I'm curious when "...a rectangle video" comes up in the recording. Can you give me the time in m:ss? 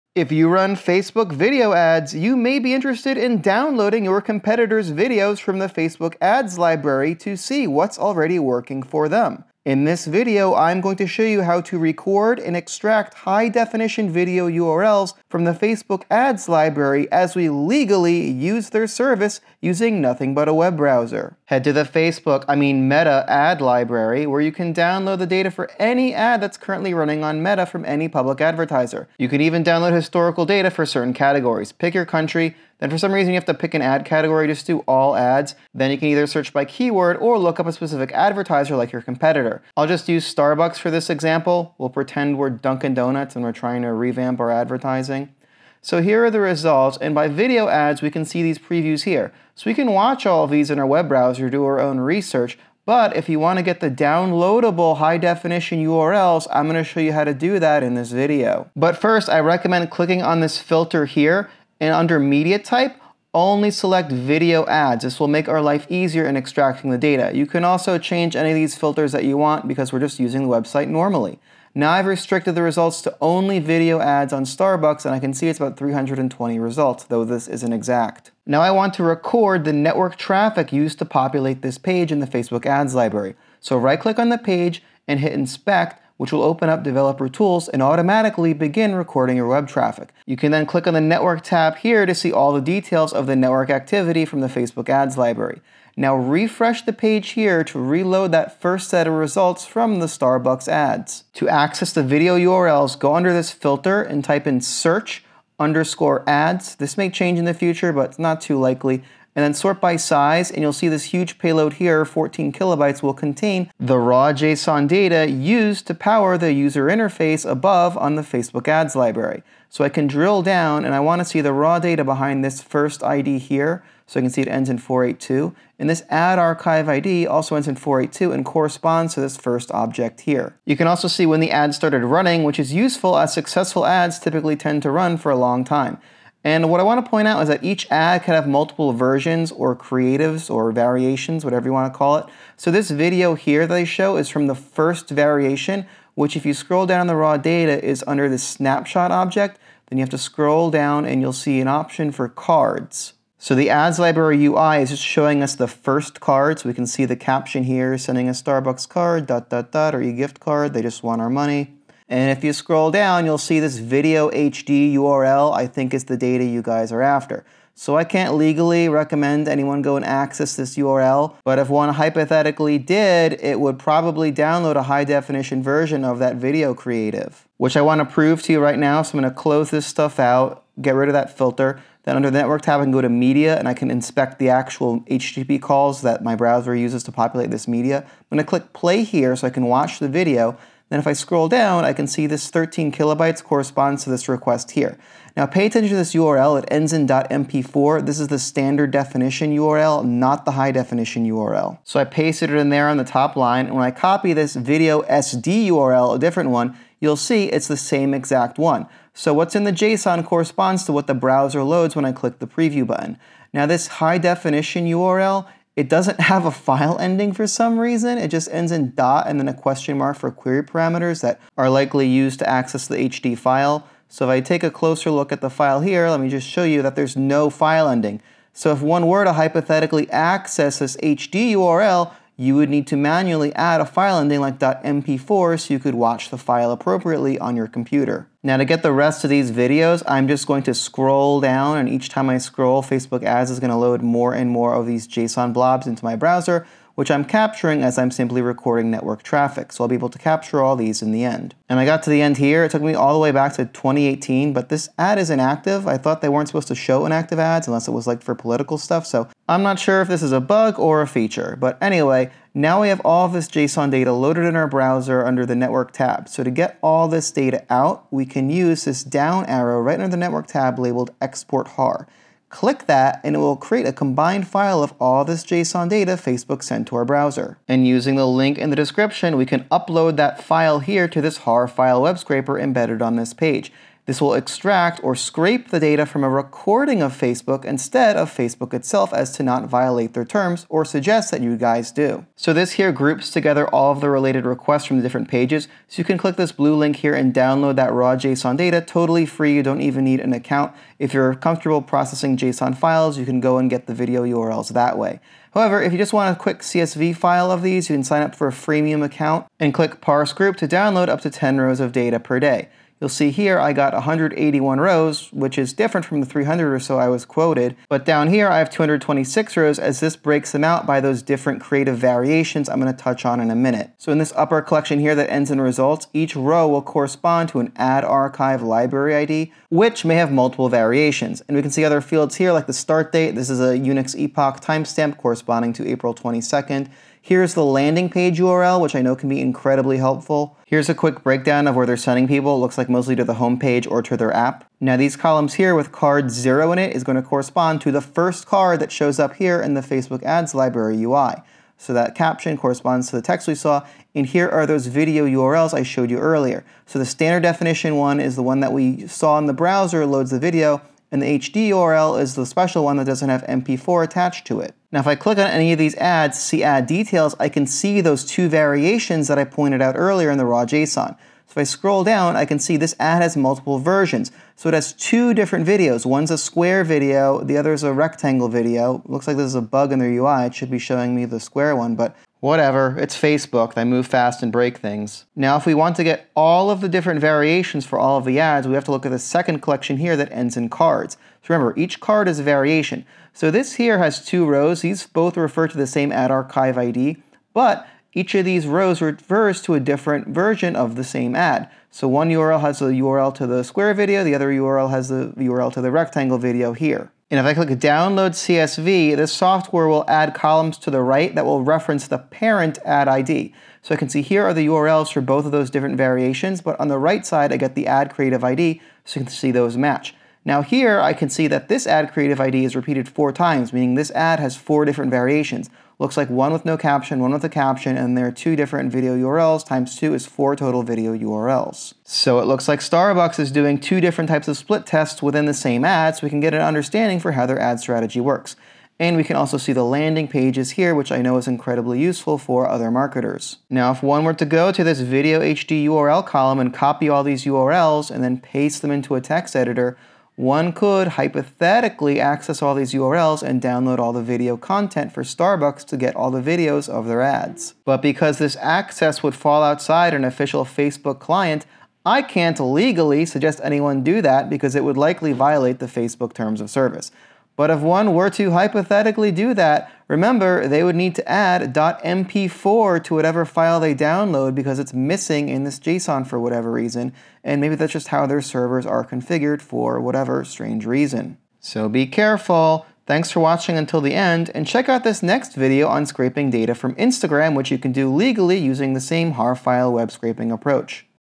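6:17.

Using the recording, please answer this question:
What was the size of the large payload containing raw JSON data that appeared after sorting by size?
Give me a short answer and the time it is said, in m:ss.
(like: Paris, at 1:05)
14 kilobytes, at 1:52.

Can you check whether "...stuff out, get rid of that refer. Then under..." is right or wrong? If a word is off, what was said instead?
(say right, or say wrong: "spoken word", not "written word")
wrong: "filter", not "refer".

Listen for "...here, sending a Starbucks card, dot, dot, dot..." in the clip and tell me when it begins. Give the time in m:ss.
2:37.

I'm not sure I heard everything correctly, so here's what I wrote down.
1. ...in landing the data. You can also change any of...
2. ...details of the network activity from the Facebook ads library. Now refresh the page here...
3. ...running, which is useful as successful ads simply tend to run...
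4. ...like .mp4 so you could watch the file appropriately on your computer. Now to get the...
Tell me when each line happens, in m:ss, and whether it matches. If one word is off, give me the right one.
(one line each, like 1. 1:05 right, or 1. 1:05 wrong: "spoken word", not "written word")
1. 1:06 wrong: "extracting", not "landing"
2. 1:32 right
3. 2:12 wrong: "typically", not "simply"
4. 3:54 right.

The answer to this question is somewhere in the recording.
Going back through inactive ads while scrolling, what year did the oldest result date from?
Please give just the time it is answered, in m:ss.
4:13.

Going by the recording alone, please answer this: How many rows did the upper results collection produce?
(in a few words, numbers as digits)
181.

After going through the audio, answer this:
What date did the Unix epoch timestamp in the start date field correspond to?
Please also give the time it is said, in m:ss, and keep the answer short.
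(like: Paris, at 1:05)
April 22nd, at 5:35.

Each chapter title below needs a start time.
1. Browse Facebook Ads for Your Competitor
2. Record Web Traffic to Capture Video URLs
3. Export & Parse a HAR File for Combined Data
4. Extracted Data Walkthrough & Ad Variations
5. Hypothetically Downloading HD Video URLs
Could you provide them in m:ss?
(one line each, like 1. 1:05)
1. 0:22
2. 1:20
3. 4:26
4. 5:24
5. 7:24.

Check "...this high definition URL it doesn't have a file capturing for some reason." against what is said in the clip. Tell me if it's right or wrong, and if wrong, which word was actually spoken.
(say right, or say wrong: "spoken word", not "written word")
wrong: "ending", not "capturing".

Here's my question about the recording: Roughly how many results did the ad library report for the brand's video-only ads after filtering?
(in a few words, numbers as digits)
320.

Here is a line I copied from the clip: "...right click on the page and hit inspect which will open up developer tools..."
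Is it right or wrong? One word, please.
right.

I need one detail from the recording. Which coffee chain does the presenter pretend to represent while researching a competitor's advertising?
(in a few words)
Dunkin' Donuts.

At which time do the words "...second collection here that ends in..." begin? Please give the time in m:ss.
6:29.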